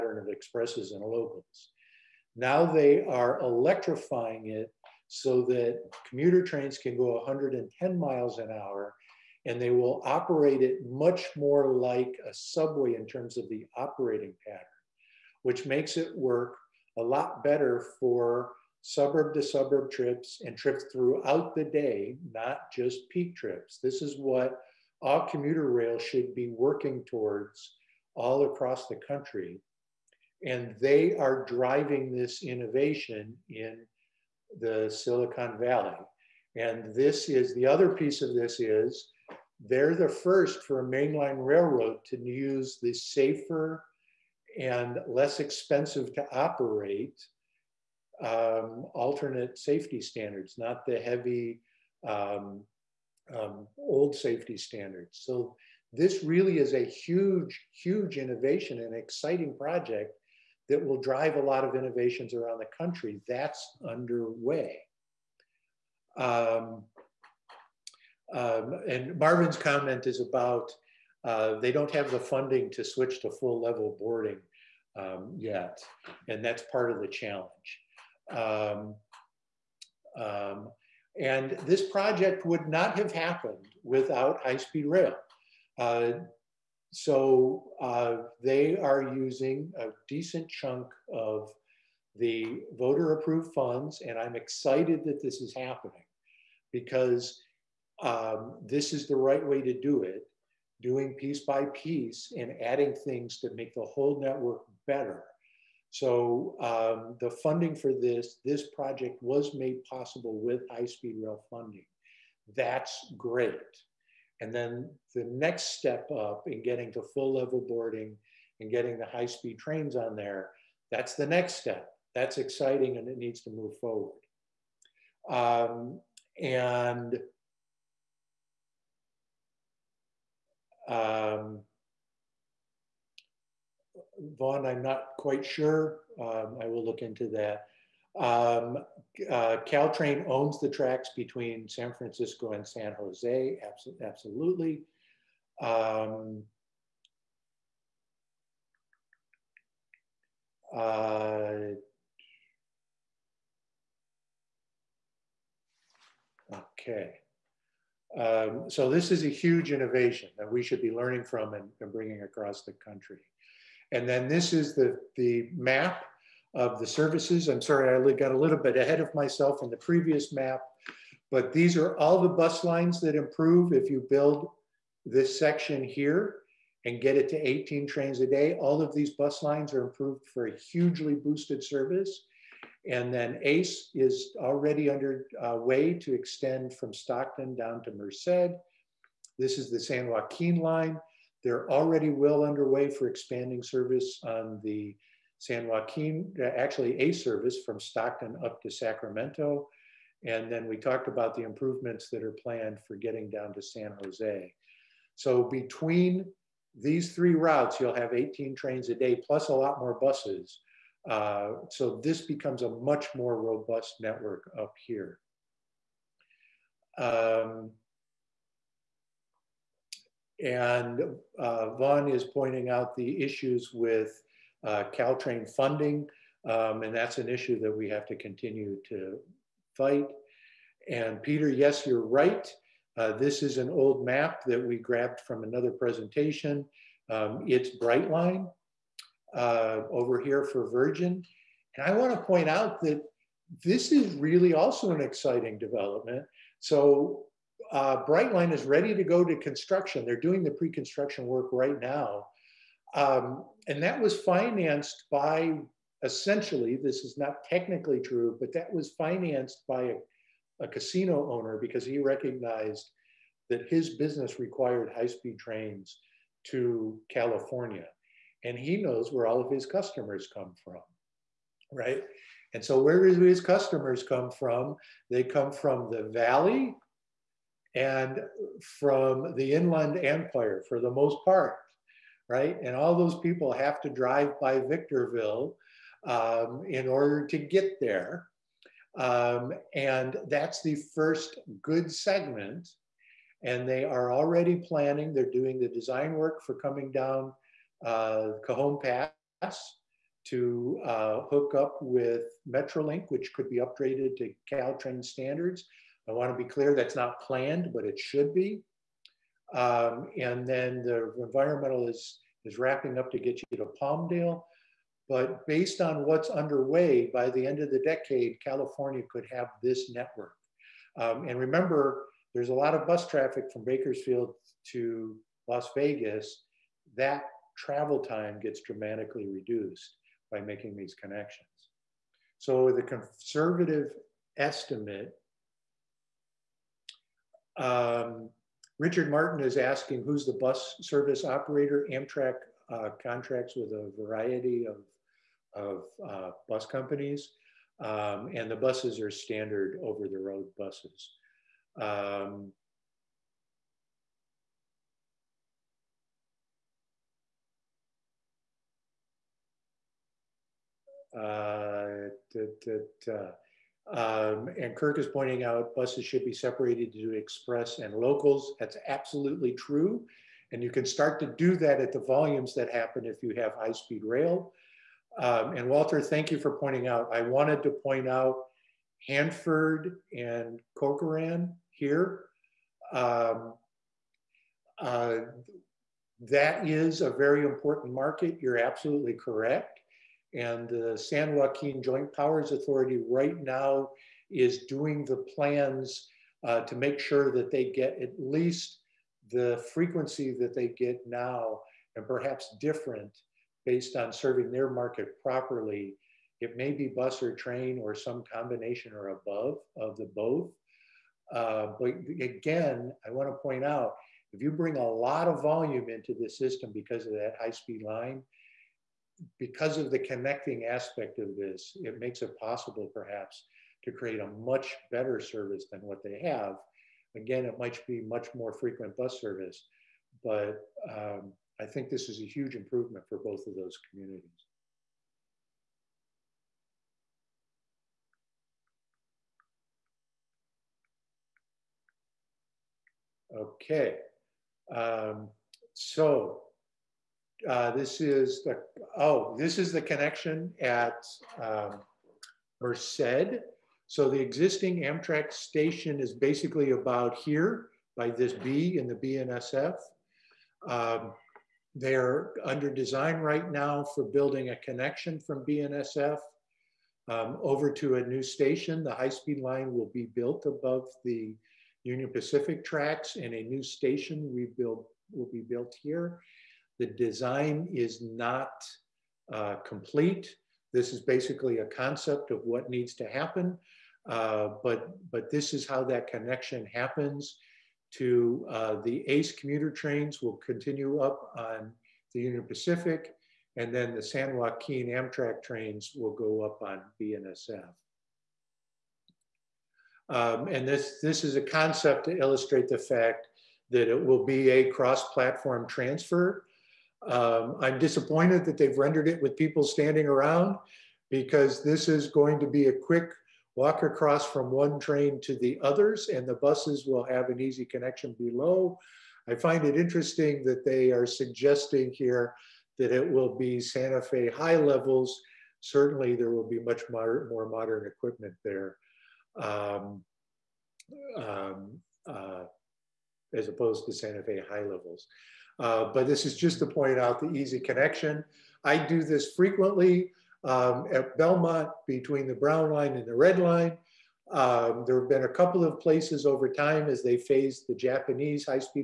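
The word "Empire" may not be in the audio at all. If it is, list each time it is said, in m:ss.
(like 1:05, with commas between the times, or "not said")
4:40.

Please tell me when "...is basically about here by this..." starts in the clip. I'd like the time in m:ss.
7:35.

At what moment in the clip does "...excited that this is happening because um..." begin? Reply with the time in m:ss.
1:34.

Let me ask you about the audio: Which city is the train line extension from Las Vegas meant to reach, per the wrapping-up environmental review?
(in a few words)
Palmdale.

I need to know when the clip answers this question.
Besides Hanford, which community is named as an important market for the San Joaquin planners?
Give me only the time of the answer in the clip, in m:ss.
6:20.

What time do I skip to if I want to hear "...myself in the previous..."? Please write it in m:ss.
2:49.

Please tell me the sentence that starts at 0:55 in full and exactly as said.
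So this really is a huge, huge innovation and exciting project that will drive a lot of innovations around the country.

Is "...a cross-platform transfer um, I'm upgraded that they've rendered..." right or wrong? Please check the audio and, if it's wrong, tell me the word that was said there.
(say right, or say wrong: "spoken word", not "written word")
wrong: "disappointed", not "upgraded".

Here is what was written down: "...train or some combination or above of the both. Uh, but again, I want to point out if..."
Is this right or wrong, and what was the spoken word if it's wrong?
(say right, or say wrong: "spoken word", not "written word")
right.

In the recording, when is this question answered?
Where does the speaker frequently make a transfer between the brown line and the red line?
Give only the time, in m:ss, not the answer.
9:01.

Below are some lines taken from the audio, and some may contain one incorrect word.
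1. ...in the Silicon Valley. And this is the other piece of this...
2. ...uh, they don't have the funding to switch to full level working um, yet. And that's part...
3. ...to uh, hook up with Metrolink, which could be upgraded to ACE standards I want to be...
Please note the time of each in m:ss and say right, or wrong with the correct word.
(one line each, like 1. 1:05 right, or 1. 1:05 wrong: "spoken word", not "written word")
1. 0:33 right
2. 1:11 wrong: "boarding", not "working"
3. 5:00 wrong: "Caltrain", not "ACE".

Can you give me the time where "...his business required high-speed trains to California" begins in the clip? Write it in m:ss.
4:23.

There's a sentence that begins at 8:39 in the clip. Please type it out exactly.
I find it interesting that they are suggesting here that it will be Santa Fe high levels.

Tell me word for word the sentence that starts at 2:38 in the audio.
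Um, so this is a huge innovation that we should be learning from and, and bringing across the country.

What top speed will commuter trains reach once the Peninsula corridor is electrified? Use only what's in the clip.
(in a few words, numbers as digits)
110 miles an hour.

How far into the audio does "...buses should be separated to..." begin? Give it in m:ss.
6:05.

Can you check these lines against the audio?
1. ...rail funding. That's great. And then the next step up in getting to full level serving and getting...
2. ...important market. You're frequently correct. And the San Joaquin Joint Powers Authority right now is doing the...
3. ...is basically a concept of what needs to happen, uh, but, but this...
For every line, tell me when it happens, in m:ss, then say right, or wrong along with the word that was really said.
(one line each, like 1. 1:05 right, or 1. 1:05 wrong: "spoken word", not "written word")
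1. 1:51 wrong: "boarding", not "serving"
2. 6:27 wrong: "absolutely", not "frequently"
3. 8:00 right.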